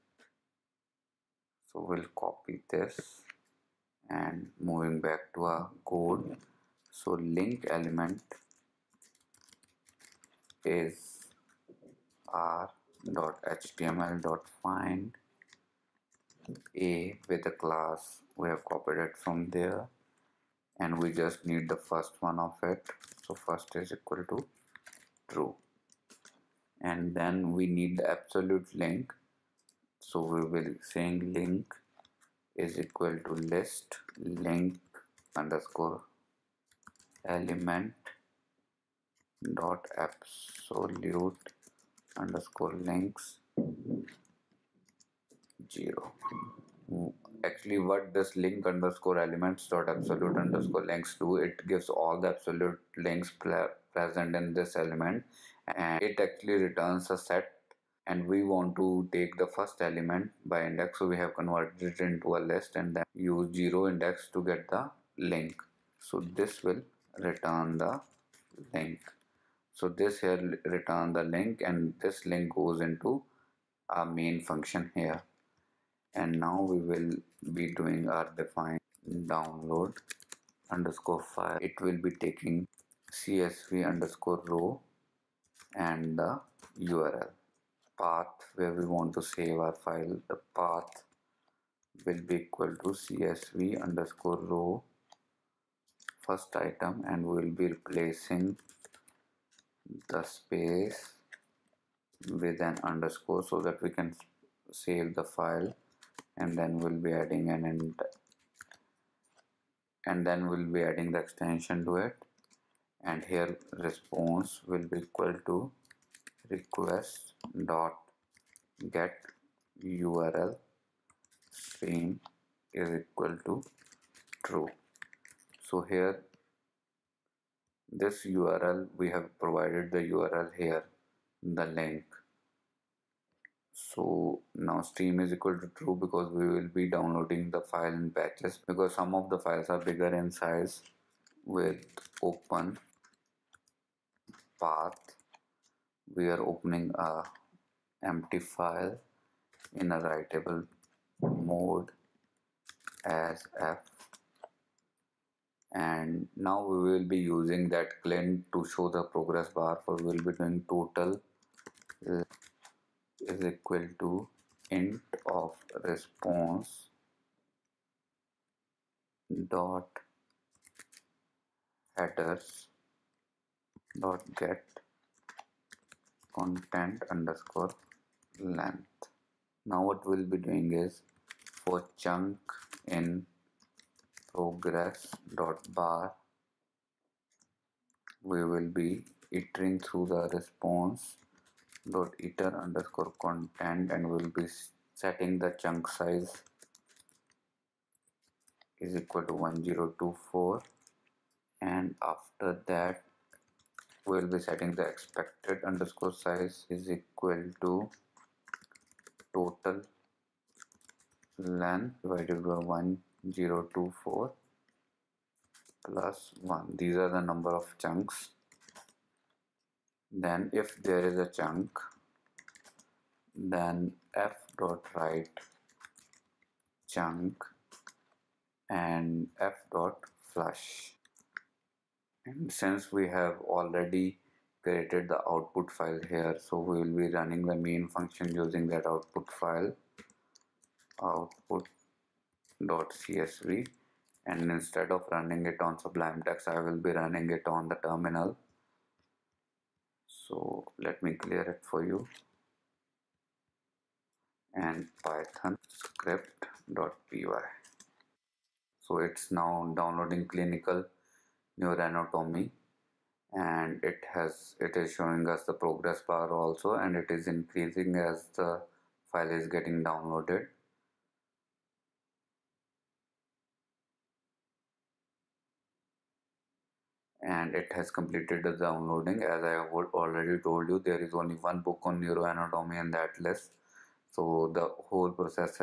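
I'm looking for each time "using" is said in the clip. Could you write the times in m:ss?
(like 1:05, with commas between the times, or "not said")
2:37, 3:58.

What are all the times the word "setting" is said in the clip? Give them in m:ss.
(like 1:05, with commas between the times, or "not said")
3:14, 3:24.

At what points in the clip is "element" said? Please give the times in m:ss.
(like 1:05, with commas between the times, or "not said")
0:07, 0:37, 0:49, 0:54, 0:59.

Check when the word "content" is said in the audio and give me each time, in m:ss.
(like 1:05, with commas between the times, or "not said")
2:56, 3:13.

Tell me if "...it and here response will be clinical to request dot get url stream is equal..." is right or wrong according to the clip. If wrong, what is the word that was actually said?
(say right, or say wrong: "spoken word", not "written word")
wrong: "equal", not "clinical".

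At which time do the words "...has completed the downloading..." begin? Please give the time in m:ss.
4:37.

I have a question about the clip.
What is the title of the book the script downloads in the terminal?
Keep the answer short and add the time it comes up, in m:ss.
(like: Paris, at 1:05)
Clinical Neuroanatomy, at 4:20.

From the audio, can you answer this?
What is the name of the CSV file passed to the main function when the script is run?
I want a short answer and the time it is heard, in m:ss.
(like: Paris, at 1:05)
output.csv, at 4:01.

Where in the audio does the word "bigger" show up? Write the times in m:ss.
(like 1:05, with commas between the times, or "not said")
2:19.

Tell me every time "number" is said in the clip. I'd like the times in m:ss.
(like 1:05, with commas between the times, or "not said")
3:37.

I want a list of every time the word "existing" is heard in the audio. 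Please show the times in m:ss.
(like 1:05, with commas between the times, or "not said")
not said.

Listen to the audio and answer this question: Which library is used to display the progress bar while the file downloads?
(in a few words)
clint.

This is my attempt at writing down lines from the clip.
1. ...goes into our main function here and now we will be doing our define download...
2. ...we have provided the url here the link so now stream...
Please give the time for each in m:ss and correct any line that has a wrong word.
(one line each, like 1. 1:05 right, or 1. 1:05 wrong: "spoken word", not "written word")
1. 1:12 right
2. 2:08 right.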